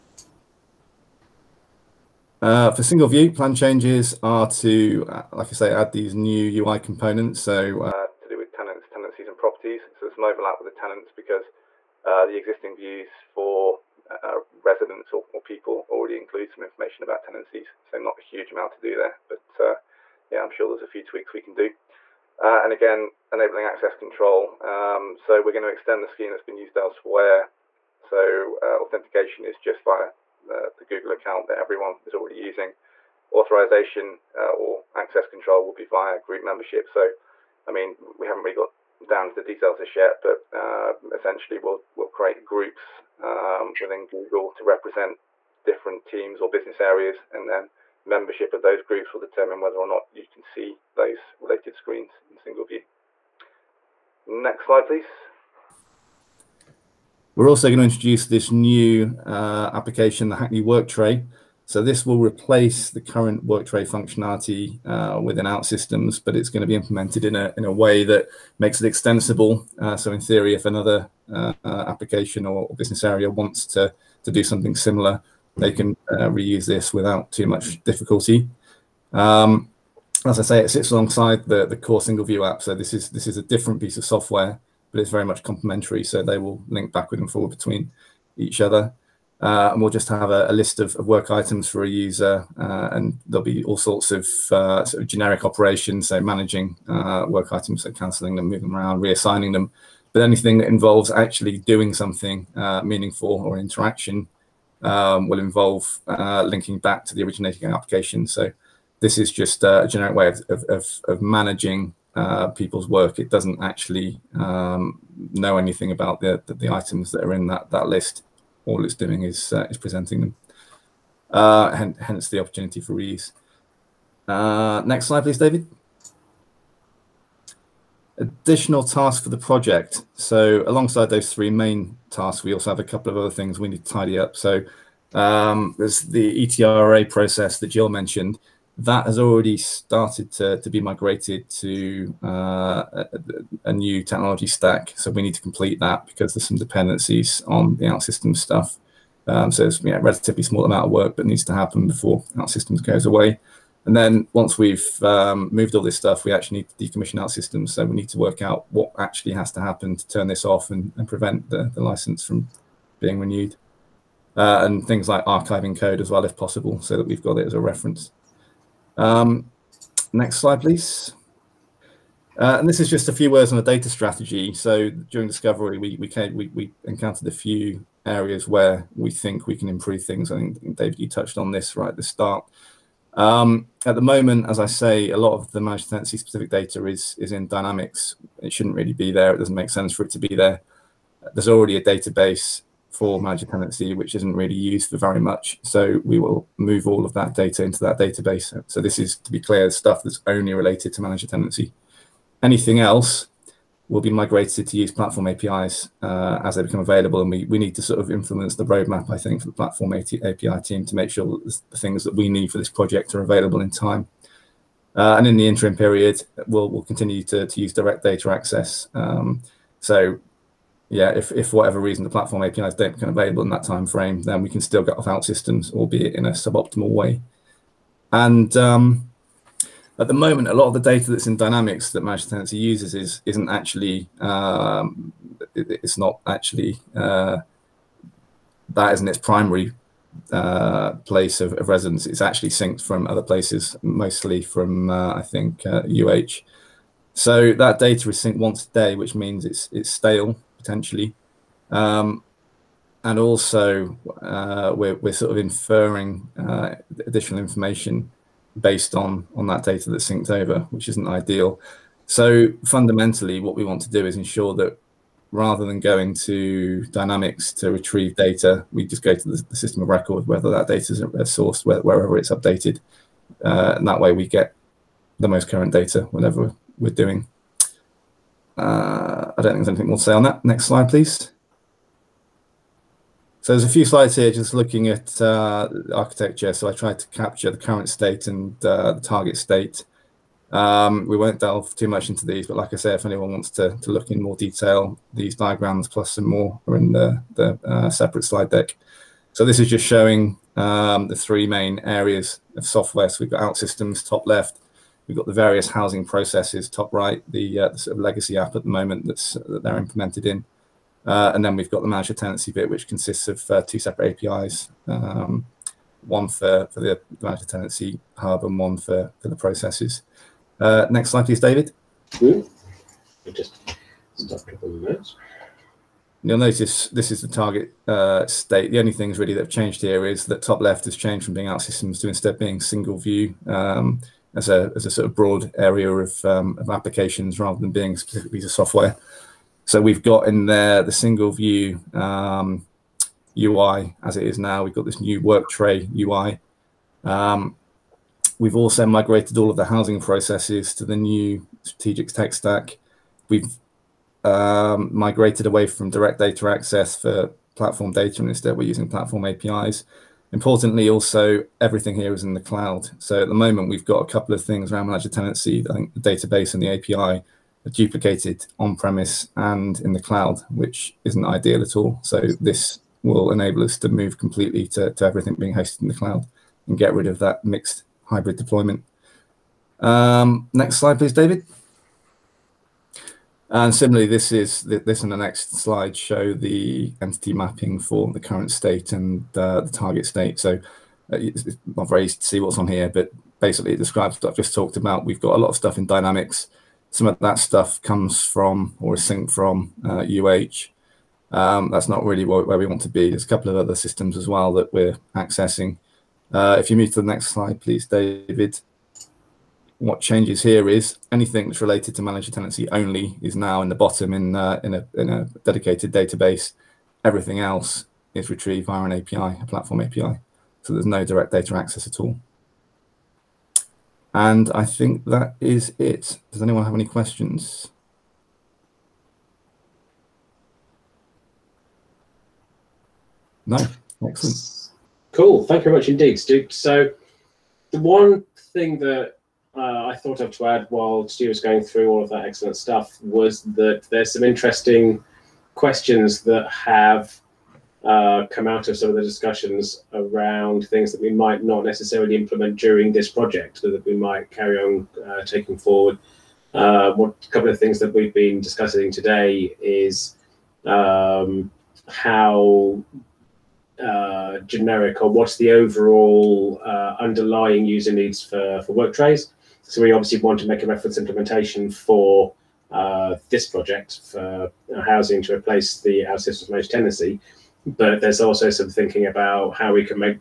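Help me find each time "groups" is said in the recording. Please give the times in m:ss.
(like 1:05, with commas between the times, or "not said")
0:36, 0:42, 0:48.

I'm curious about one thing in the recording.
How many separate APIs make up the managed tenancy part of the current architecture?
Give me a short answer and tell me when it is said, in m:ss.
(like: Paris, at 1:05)
2, at 5:13.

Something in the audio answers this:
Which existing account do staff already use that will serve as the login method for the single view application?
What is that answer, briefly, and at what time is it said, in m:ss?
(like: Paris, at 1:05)
Google account, at 0:30.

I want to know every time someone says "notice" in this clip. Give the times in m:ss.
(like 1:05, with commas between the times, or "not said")
5:26.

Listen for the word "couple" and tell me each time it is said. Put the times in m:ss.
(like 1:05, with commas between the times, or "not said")
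2:12, 6:04, 6:43, 7:37.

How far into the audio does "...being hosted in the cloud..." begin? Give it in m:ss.
6:15.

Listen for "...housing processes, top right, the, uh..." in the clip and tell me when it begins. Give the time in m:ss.
5:05.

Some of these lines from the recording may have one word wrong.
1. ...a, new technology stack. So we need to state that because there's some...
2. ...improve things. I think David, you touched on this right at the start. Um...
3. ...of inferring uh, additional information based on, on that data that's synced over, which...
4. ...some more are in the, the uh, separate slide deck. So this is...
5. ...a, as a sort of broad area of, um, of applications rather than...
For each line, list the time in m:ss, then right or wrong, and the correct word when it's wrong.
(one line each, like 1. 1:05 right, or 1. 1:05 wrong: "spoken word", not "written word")
1. 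2:23 wrong: "complete", not "state"
2. 2:59 right
3. 4:15 right
4. 4:56 right
5. 5:34 right.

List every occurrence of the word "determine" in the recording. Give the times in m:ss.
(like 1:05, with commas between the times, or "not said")
0:49.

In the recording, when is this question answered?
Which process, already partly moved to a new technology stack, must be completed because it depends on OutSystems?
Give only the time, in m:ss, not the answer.
2:16.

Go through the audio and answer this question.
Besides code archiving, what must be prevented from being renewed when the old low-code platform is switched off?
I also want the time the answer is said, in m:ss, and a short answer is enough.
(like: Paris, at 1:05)
The license, at 2:41.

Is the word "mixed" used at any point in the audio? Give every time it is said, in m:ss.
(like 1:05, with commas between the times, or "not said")
6:17.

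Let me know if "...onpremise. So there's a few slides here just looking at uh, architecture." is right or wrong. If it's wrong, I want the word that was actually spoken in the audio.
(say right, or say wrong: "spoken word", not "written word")
wrong: "please", not "onpremise".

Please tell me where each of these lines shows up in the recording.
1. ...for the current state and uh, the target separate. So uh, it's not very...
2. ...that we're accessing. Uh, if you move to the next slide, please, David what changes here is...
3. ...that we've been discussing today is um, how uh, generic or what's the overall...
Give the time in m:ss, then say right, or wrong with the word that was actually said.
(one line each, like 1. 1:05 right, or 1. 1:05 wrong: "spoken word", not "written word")
1. 6:27 wrong: "state", not "separate"
2. 6:44 right
3. 7:37 right.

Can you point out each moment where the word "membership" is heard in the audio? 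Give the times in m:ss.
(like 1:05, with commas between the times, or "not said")
0:36, 0:48.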